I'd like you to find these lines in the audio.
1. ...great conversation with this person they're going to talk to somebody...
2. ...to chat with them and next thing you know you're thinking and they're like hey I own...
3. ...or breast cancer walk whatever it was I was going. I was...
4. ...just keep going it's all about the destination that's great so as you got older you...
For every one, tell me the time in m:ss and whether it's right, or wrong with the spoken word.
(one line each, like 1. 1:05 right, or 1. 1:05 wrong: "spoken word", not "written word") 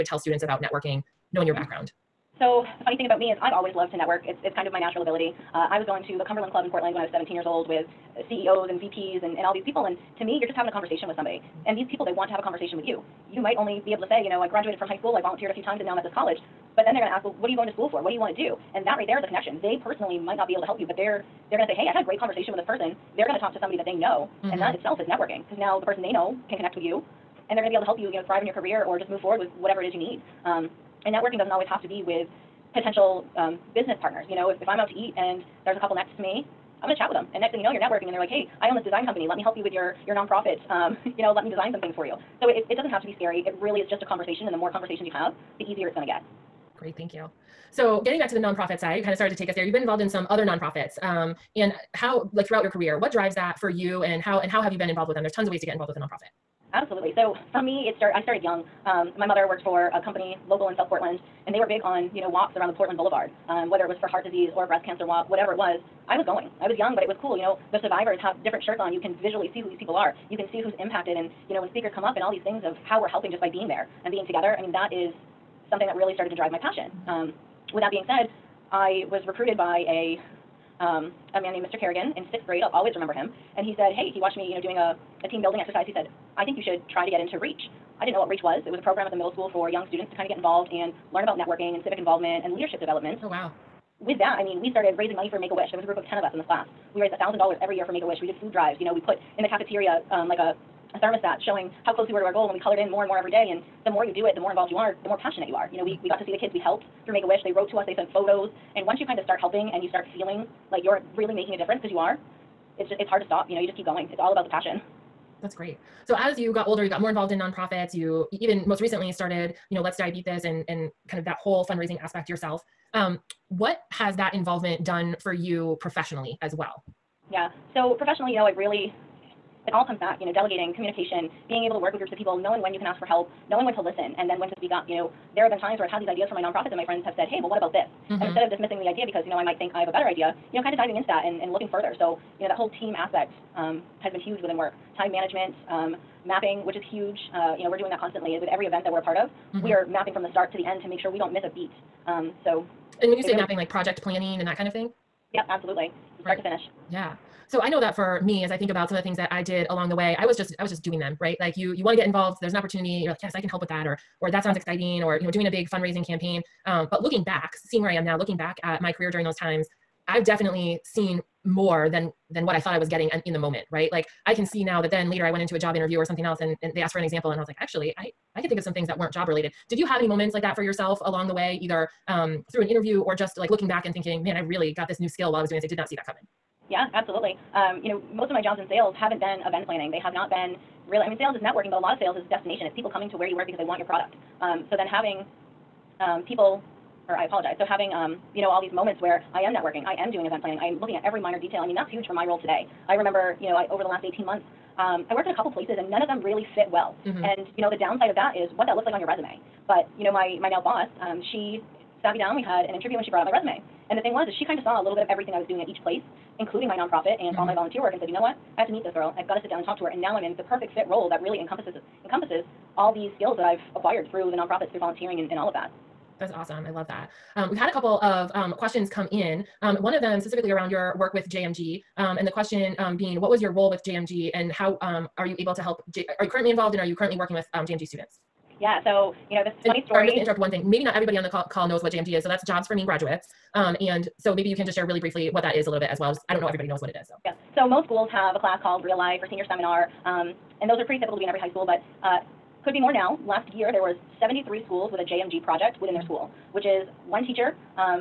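1. 0:22 right
2. 0:36 wrong: "networking", not "thinking"
3. 1:04 right
4. 1:53 wrong: "passion", not "destination".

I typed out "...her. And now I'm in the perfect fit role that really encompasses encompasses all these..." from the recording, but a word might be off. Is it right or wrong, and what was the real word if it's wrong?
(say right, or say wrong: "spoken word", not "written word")
right.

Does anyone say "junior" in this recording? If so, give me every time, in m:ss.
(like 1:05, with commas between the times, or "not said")
not said.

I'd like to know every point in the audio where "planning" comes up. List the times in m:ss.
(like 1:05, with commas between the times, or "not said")
2:34, 3:09, 3:20.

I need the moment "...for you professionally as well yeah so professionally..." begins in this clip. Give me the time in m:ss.
2:05.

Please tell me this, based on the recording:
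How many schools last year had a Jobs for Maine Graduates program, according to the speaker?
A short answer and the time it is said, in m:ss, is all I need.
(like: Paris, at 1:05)
73, at 4:14.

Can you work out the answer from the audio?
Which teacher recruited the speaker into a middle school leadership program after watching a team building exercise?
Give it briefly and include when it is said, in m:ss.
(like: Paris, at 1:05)
Mr. Kerrigan, at 1:21.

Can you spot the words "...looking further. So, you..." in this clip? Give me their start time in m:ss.
2:21.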